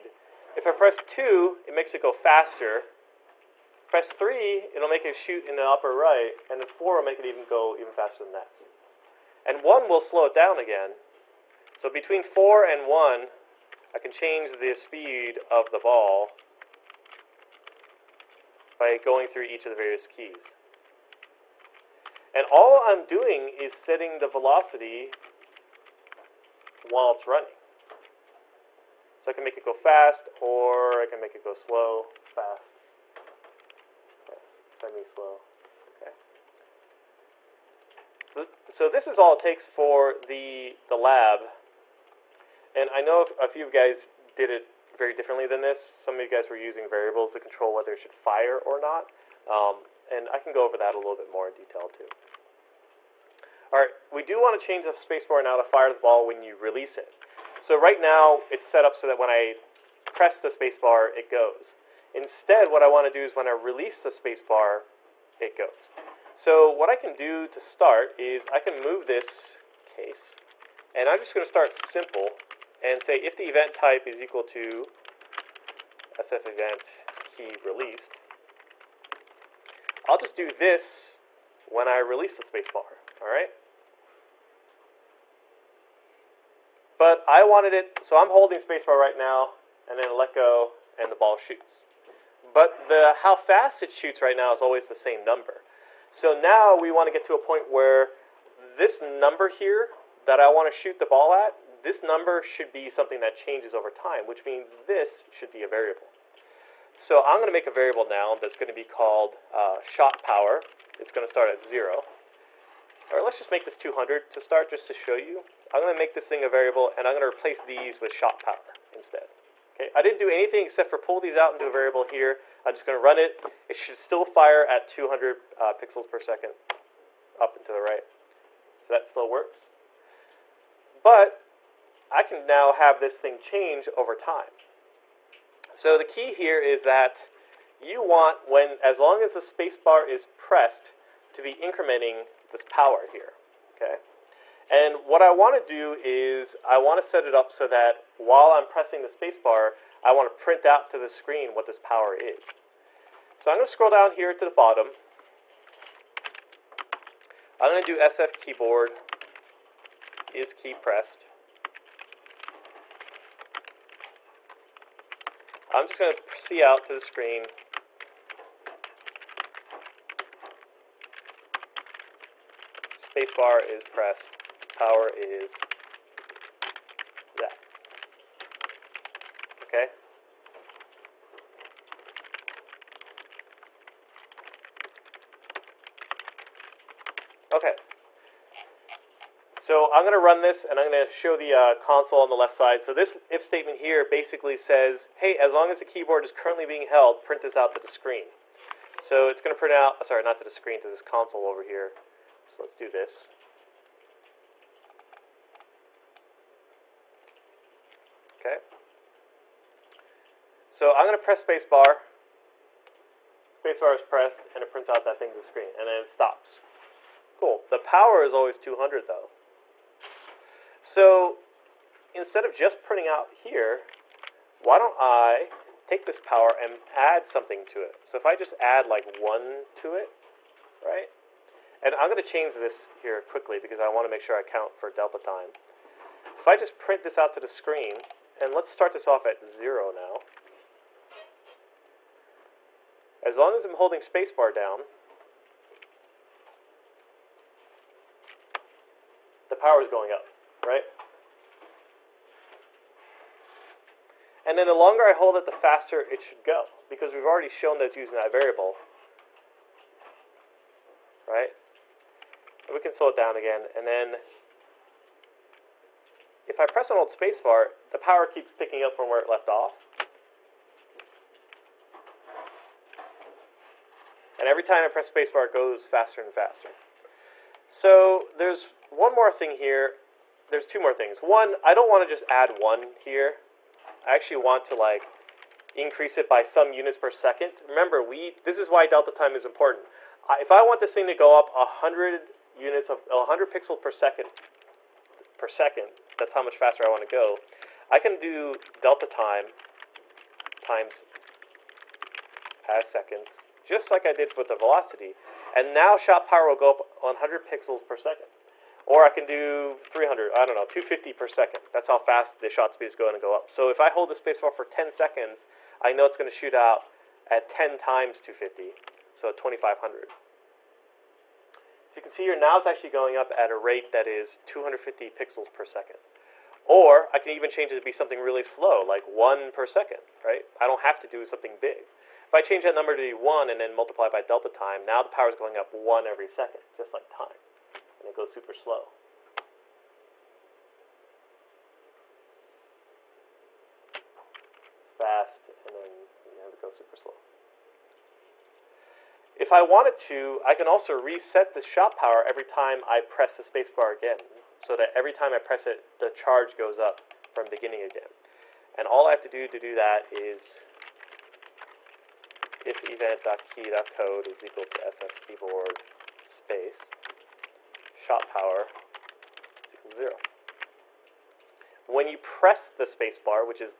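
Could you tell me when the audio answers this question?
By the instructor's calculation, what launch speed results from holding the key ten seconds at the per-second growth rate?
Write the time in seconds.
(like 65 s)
319 s.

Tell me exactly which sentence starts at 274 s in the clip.
And every time I press spacebar, it goes faster and faster.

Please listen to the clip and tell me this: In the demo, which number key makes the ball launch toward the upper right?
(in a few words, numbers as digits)
3.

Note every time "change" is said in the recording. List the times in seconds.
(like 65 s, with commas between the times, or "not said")
14 s, 54 s, 103 s, 133 s, 232 s, 327 s, 332 s.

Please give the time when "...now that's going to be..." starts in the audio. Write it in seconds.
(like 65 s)
108 s.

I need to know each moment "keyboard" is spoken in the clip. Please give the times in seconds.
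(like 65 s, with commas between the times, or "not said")
158 s, 195 s, 365 s.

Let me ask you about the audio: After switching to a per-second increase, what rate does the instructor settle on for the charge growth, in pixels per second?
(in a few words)
250.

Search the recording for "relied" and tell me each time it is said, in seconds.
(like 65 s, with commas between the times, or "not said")
not said.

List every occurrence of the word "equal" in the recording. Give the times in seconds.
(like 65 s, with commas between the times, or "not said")
74 s, 364 s, 369 s.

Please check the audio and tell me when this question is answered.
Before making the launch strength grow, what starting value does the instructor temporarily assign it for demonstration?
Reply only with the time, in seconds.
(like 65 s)
113 s.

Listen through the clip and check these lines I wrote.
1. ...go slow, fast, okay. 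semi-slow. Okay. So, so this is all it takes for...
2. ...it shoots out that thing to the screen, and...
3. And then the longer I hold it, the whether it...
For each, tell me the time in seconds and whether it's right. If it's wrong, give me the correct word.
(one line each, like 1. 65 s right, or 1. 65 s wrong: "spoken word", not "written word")
1. 31 s right
2. 214 s wrong: "prints", not "shoots"
3. 254 s wrong: "faster", not "whether".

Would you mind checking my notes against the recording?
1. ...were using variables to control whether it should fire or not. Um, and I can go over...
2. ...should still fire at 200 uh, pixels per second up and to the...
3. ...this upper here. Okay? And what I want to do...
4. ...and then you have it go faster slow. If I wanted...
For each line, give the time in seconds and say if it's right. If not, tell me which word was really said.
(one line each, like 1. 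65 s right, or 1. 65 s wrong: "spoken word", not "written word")
1. 46 s right
2. 123 s right
3. 142 s wrong: "power", not "upper"
4. 345 s wrong: "super", not "faster".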